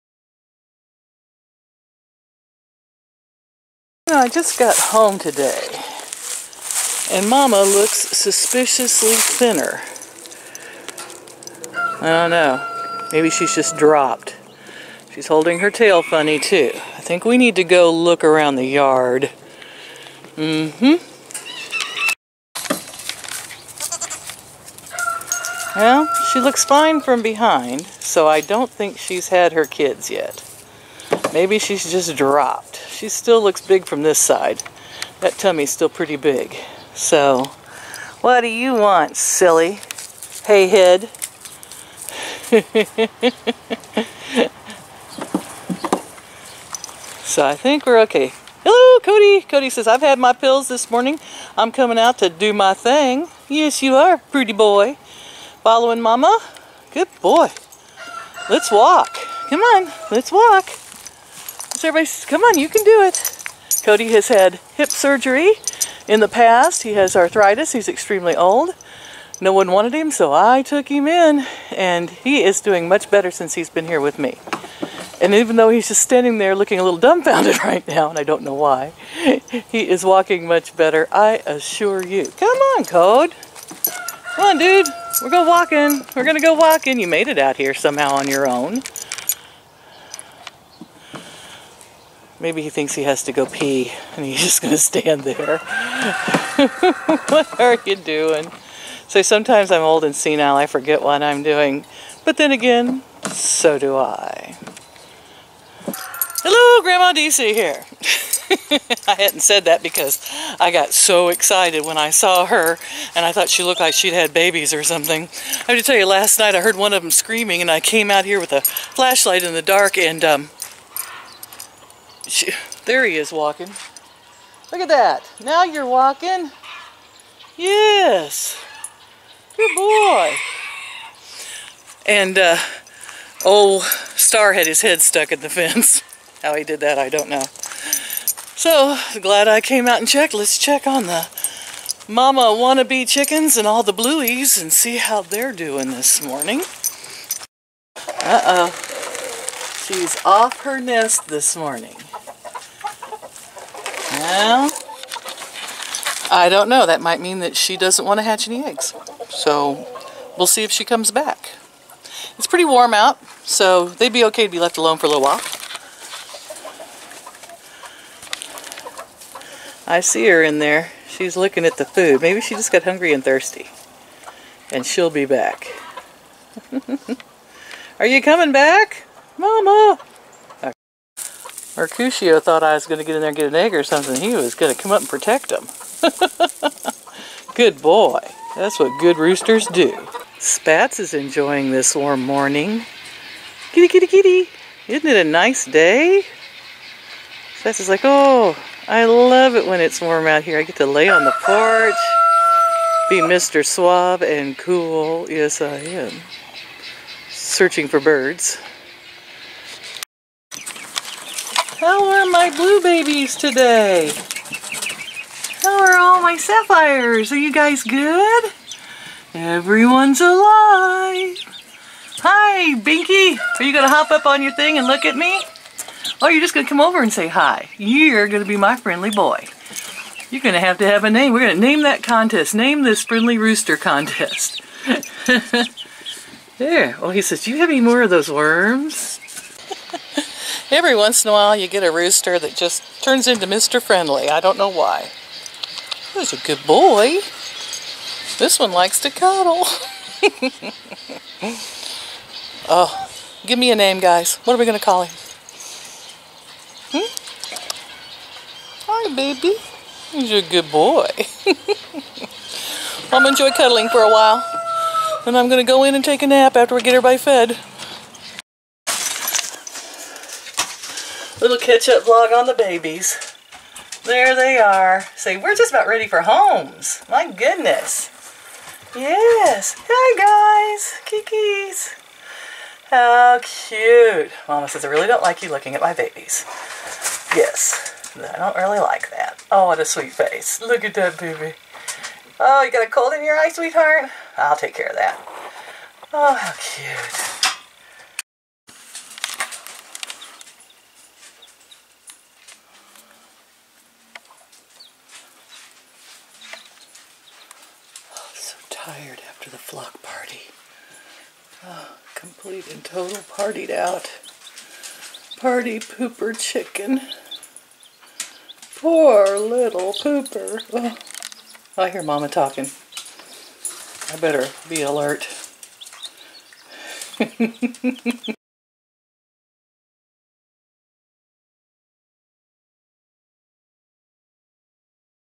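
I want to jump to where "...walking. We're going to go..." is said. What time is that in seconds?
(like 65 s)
85 s.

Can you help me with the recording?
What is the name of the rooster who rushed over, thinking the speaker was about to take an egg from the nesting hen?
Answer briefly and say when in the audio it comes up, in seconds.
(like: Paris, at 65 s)
Mercutio, at 181 s.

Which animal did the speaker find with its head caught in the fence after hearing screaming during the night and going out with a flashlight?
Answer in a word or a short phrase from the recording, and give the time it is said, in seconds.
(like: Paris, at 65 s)
Star, at 134 s.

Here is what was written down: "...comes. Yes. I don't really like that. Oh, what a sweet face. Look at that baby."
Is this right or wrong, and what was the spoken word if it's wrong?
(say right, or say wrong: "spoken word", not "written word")
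wrong: "babies", not "comes".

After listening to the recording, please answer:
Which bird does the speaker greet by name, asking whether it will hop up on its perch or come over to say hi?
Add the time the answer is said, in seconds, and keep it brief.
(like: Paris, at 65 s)
Binky, at 222 s.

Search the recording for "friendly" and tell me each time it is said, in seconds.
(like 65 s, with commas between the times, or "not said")
228 s, 233 s, 243 s.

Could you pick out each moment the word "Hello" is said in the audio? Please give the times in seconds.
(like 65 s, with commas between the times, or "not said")
48 s, 106 s.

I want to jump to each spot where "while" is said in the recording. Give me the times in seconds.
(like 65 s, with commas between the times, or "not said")
165 s, 241 s, 264 s.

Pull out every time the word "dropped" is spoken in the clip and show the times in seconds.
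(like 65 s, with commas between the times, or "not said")
13 s, 32 s.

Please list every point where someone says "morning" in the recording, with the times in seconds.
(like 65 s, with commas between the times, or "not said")
50 s, 146 s, 151 s, 192 s.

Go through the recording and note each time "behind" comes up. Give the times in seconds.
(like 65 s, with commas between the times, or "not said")
27 s.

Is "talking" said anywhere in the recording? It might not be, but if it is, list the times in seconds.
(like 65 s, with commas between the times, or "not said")
322 s.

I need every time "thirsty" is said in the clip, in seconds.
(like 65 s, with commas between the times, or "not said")
173 s.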